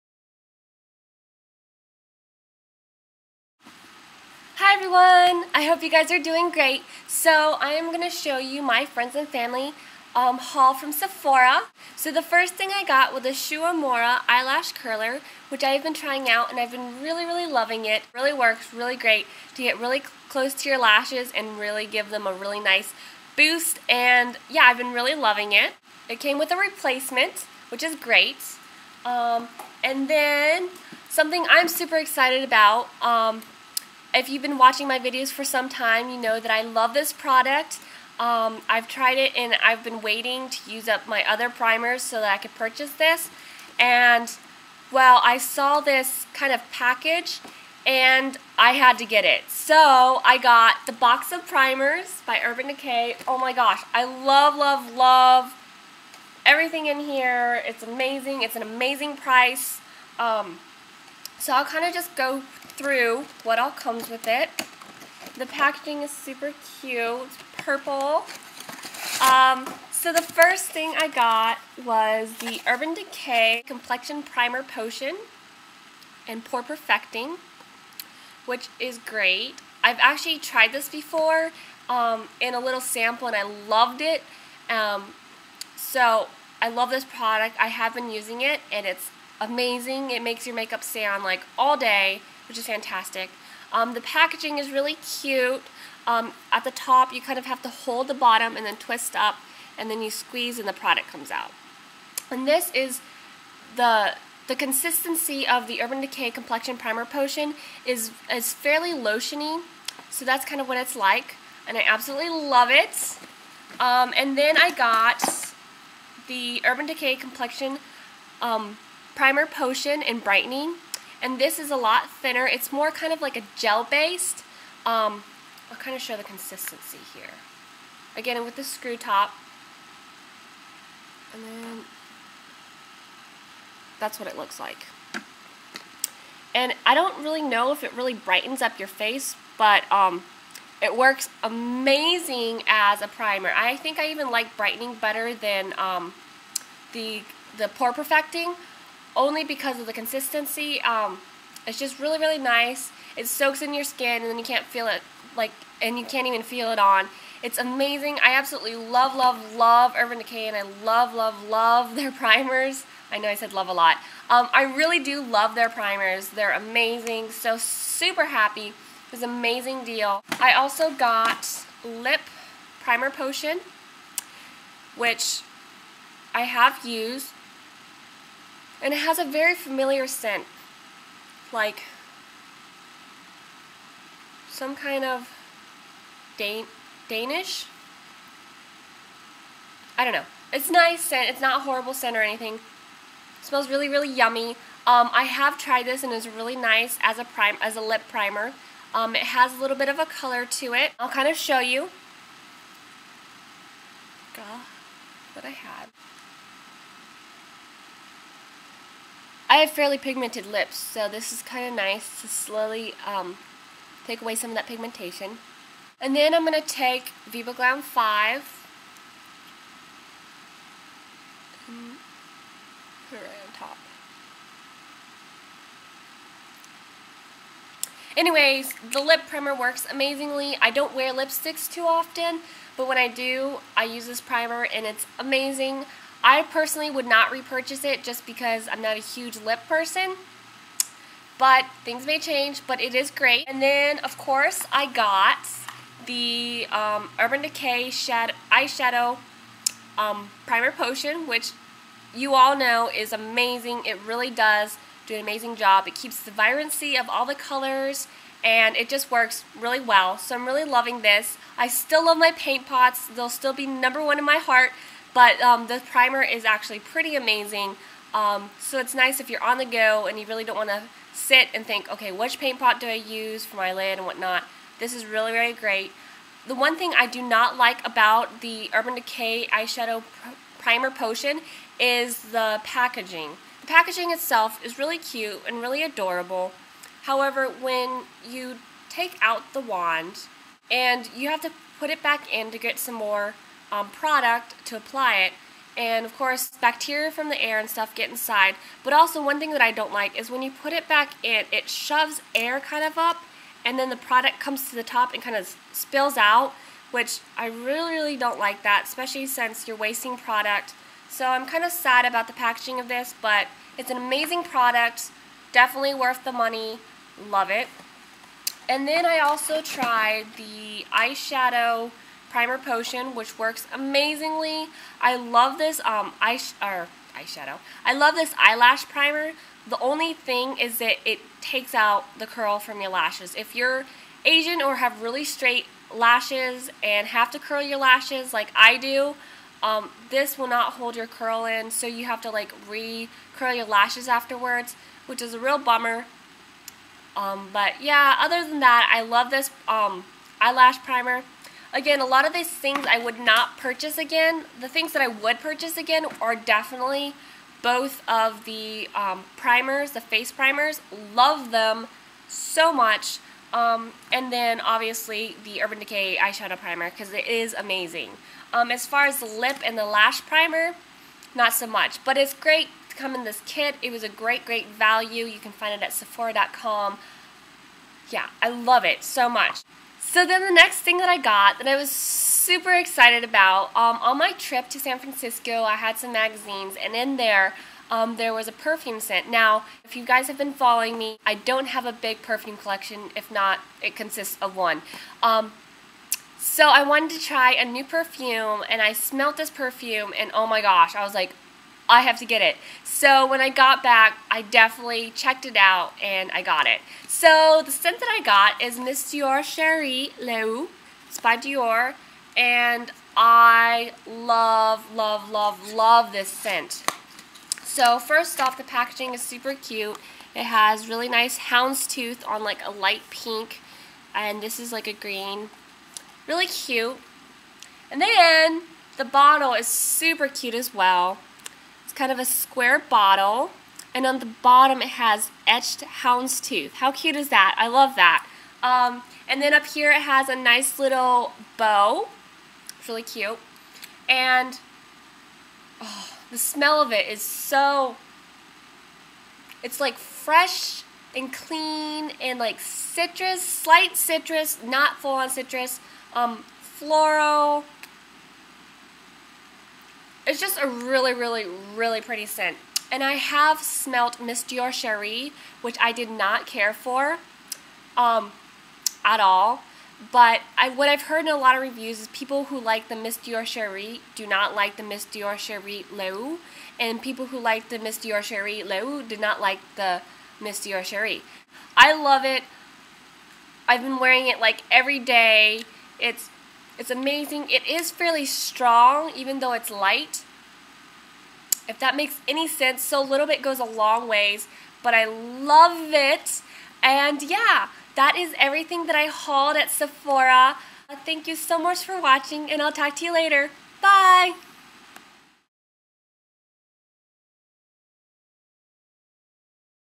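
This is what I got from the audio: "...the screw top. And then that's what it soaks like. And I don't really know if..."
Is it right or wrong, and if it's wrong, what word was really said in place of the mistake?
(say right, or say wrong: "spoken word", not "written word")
wrong: "looks", not "soaks".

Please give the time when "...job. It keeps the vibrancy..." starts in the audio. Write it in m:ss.
4:15.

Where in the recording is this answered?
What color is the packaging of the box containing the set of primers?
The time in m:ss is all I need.
1:07.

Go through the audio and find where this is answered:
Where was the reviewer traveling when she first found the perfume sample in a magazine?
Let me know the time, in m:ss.
6:24.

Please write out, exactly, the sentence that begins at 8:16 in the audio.
And yeah, that is everything that I hauled at Sephora.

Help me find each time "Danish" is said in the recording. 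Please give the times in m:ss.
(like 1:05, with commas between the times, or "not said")
3:07.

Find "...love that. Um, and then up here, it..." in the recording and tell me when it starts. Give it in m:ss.
7:17.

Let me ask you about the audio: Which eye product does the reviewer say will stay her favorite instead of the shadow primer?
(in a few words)
Paint pots.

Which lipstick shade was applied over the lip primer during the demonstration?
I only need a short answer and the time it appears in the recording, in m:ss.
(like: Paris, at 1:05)
Viva Glam 5, at 3:37.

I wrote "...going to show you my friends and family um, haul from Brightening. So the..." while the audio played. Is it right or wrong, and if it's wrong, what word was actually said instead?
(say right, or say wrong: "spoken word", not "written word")
wrong: "Sephora", not "Brightening".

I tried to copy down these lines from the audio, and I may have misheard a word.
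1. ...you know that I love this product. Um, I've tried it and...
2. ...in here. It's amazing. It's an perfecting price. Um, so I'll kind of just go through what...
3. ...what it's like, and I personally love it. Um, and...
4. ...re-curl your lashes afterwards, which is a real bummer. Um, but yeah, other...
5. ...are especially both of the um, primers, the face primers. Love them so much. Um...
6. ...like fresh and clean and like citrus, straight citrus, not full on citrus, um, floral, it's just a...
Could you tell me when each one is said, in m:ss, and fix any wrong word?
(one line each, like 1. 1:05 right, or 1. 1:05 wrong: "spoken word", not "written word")
1. 0:36 right
2. 0:56 wrong: "amazing", not "perfecting"
3. 1:50 wrong: "absolutely", not "personally"
4. 5:42 right
5. 5:56 wrong: "definitely", not "especially"
6. 7:29 wrong: "slight", not "straight".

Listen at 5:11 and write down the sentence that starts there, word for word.
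So I'm kind of sad about the packaging of this, but it's an amazing product, definitely worth the money, love it.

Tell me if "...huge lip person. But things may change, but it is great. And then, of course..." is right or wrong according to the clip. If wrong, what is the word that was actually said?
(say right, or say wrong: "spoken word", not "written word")
right.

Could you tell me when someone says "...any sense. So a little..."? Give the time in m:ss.
8:12.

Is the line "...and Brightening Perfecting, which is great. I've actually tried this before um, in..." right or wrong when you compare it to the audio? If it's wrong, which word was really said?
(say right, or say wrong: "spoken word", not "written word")
wrong: "Pore", not "Brightening".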